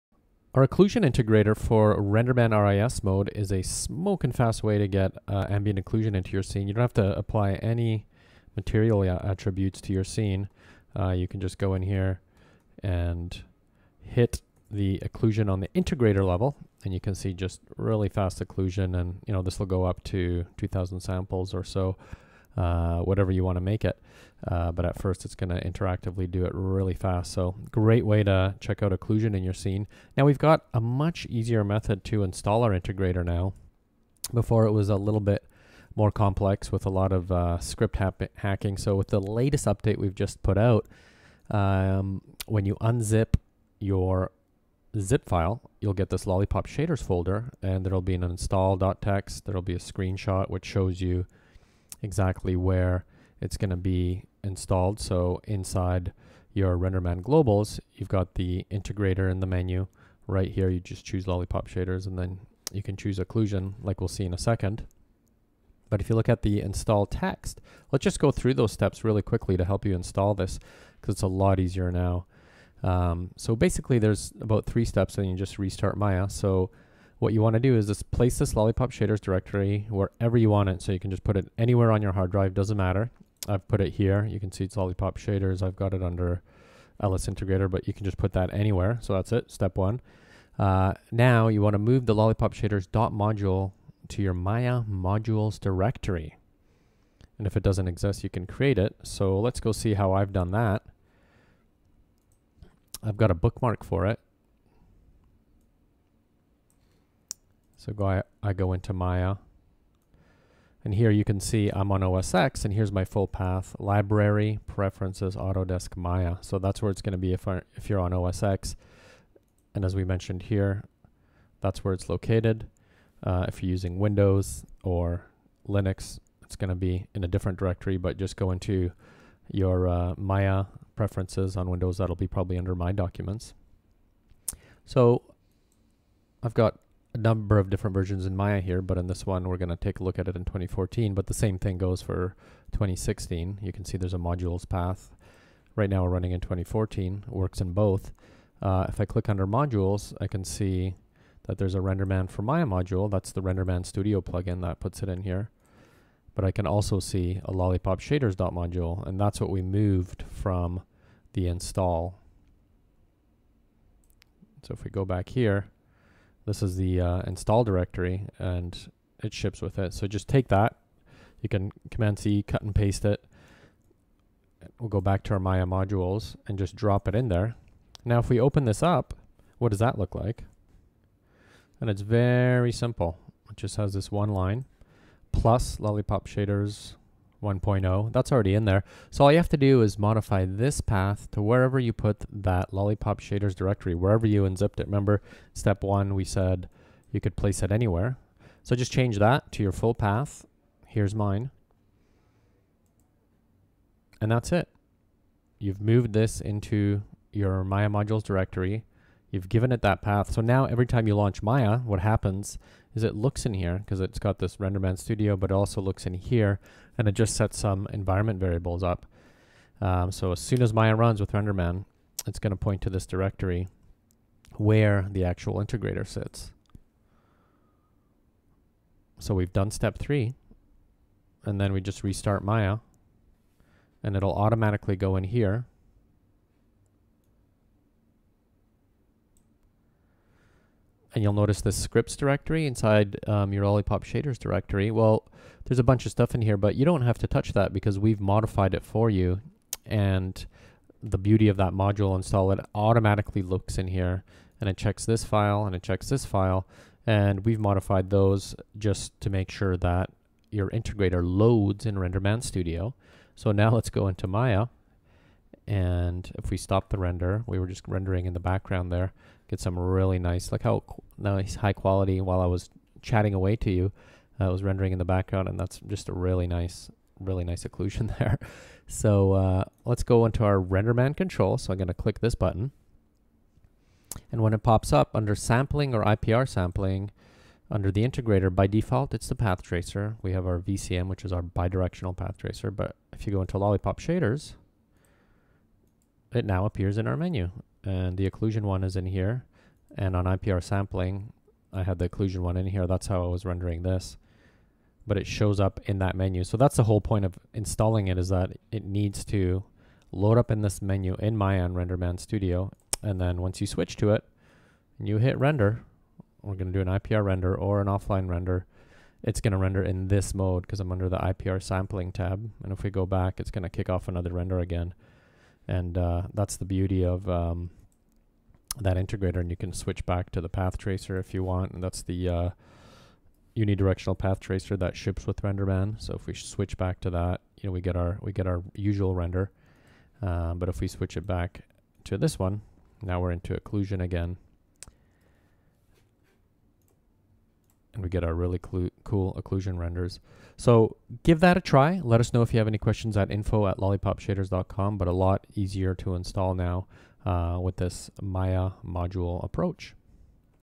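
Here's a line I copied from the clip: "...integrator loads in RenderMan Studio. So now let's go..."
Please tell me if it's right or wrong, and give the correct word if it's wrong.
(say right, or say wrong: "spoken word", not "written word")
right.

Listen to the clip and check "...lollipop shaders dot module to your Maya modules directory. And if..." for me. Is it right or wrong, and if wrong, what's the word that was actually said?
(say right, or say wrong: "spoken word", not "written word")
right.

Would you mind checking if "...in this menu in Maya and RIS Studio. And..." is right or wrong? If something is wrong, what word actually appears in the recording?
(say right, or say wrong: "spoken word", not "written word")
wrong: "RenderMan", not "RIS".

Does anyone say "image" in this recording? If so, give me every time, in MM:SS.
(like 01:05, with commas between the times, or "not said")
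not said.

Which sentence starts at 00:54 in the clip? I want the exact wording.
So inside your RenderMan globals, you've got the integrator in the menu.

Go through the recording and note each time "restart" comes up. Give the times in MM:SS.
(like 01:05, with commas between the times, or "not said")
01:15, 03:52.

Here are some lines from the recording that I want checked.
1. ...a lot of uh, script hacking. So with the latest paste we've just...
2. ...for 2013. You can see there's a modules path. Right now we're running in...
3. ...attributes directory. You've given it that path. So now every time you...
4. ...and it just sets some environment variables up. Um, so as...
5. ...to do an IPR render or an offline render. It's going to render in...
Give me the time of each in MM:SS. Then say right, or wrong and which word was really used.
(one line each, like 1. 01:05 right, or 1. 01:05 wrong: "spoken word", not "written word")
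1. 00:36 wrong: "update", not "paste"
2. 02:22 wrong: "2016", not "2013"
3. 03:27 wrong: "modules", not "attributes"
4. 03:36 right
5. 05:16 right.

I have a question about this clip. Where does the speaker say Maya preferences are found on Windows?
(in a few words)
My Documents.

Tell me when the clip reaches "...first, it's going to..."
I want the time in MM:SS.
00:24.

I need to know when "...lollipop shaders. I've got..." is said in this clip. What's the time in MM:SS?
01:24.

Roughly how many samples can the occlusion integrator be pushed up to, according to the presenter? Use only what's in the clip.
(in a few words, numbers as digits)
2000.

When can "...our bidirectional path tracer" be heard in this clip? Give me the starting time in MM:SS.
04:51.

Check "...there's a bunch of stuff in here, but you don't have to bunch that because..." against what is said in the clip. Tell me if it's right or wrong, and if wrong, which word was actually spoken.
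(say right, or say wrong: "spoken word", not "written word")
wrong: "touch", not "bunch".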